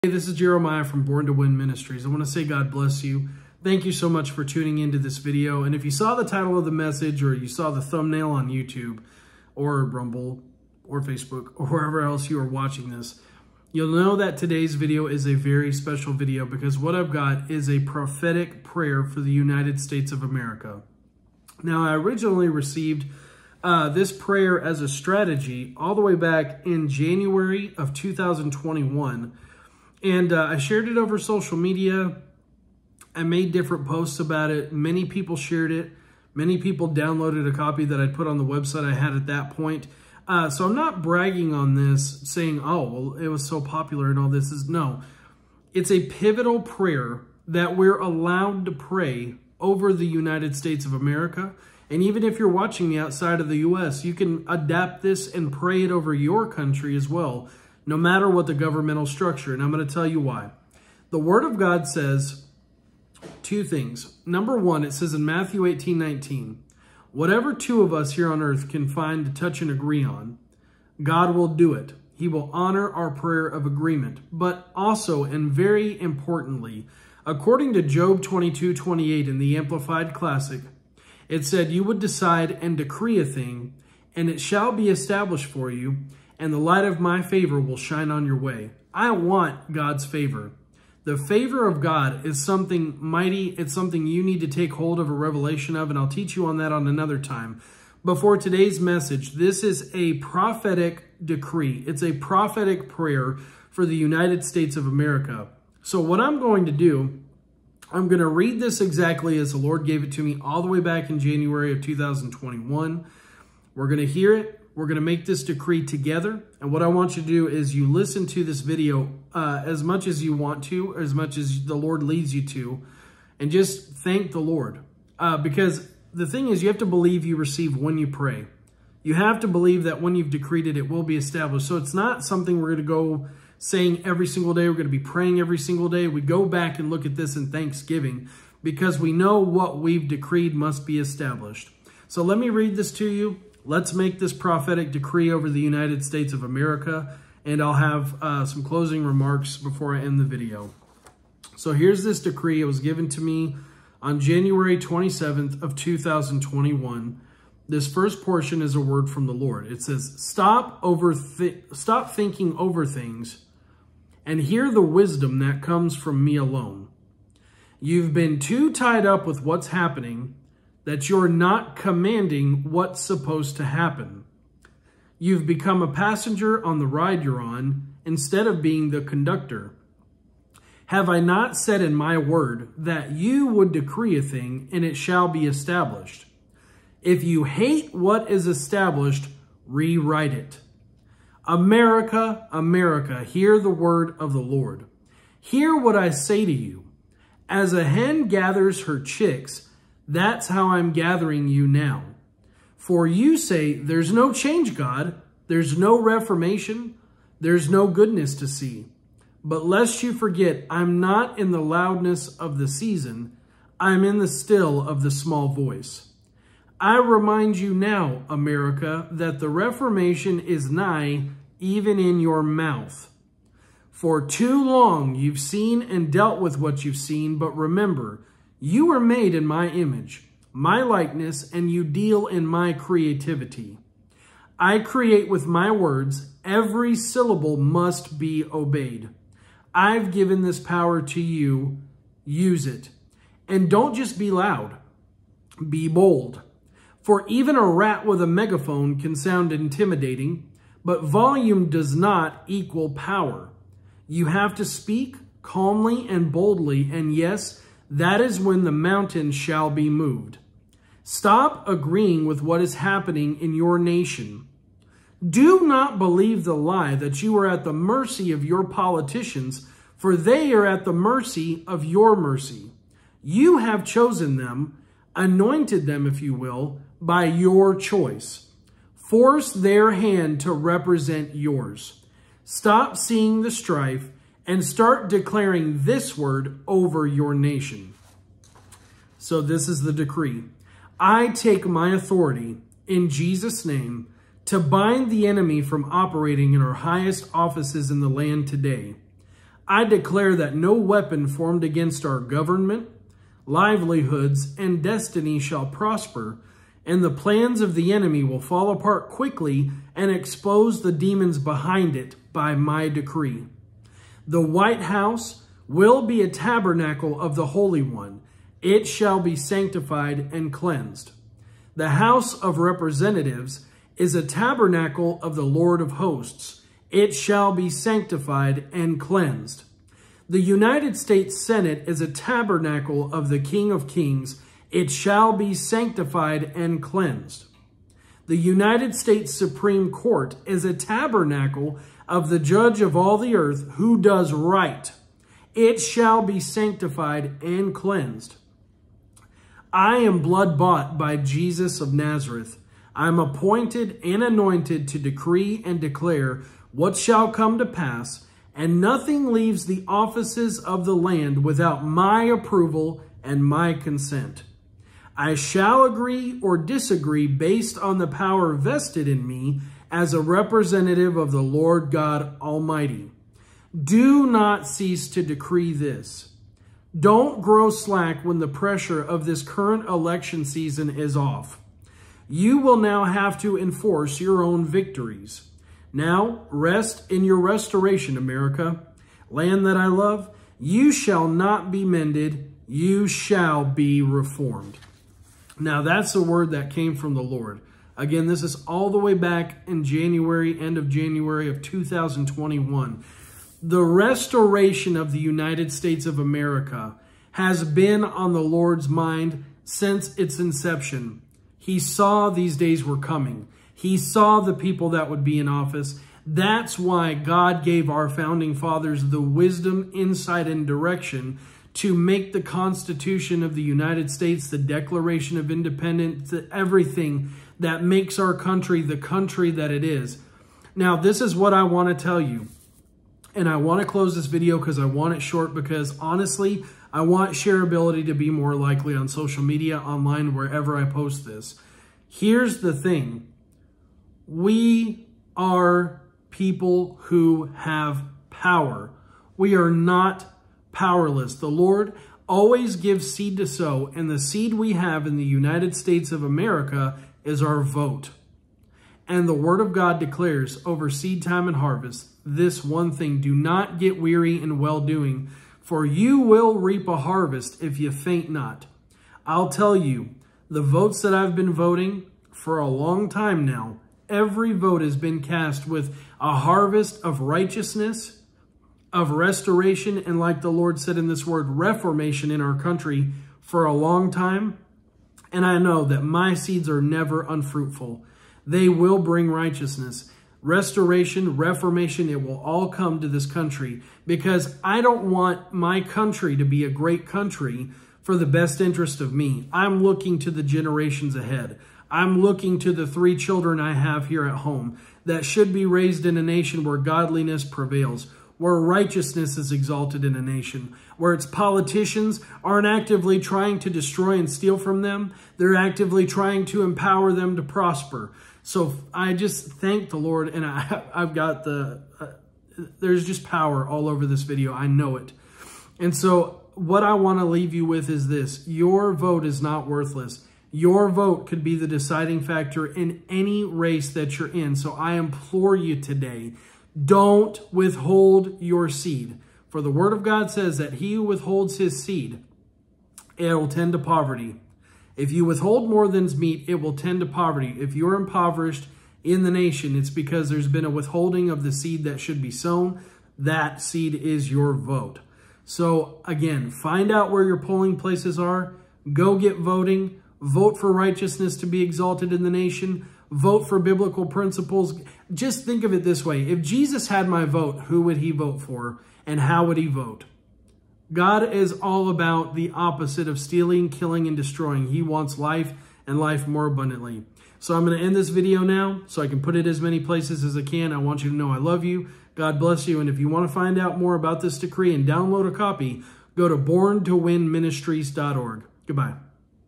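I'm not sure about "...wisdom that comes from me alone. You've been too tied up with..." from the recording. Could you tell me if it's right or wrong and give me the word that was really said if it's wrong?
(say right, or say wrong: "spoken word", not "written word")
right.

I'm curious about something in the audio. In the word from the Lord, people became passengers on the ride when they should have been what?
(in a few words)
The conductor.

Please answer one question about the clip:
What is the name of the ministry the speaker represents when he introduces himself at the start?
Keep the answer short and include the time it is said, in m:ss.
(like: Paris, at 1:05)
Born to Win Ministries, at 0:01.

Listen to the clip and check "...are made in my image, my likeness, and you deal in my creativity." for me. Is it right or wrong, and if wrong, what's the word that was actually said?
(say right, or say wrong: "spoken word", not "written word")
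right.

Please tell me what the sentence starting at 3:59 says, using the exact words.
I've given this power to you, use it.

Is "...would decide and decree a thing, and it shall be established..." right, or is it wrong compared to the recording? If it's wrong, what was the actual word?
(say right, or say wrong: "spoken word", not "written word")
right.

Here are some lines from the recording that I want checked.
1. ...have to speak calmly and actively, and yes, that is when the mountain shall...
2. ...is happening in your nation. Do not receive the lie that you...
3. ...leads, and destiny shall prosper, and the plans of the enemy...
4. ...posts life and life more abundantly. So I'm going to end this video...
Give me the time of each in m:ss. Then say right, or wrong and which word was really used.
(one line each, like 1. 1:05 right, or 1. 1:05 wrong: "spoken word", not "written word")
1. 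4:14 wrong: "boldly", not "actively"
2. 4:22 wrong: "believe", not "receive"
3. 5:03 wrong: "livelihoods", not "leads"
4. 9:34 wrong: "wants", not "posts".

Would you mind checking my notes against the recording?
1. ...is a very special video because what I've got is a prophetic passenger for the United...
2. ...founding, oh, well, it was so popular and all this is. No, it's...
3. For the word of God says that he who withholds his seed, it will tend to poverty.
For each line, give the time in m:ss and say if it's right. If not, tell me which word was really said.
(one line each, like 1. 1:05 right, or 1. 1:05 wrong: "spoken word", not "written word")
1. 0:15 wrong: "prayer", not "passenger"
2. 0:42 wrong: "saying", not "founding"
3. 8:59 right.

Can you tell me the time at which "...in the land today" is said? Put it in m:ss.
4:57.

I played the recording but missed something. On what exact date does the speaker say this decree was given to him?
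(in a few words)
January 27, 2021.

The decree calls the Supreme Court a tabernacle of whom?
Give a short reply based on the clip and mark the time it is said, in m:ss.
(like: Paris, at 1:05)
The judge of all the earth, at 5:42.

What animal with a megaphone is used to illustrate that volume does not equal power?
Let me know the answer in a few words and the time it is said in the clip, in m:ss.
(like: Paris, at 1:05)
A rat, at 4:07.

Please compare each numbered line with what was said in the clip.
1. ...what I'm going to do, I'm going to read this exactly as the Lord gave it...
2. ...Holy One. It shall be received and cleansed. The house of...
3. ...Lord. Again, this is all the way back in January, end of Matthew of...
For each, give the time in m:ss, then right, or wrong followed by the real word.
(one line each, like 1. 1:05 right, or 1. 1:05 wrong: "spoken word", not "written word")
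1. 1:45 right
2. 5:17 wrong: "sanctified", not "received"
3. 6:37 wrong: "January", not "Matthew".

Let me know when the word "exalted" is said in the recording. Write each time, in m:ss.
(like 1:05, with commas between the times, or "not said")
8:29, 9:21.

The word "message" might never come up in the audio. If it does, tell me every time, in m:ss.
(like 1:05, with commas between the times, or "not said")
0:06, 1:38.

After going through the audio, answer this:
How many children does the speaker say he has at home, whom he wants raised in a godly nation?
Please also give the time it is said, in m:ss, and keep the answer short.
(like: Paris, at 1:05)
3, at 8:22.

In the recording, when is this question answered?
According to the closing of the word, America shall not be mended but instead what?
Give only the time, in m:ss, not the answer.
6:34.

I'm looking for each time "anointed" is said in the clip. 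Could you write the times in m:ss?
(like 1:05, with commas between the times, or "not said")
4:35, 5:54.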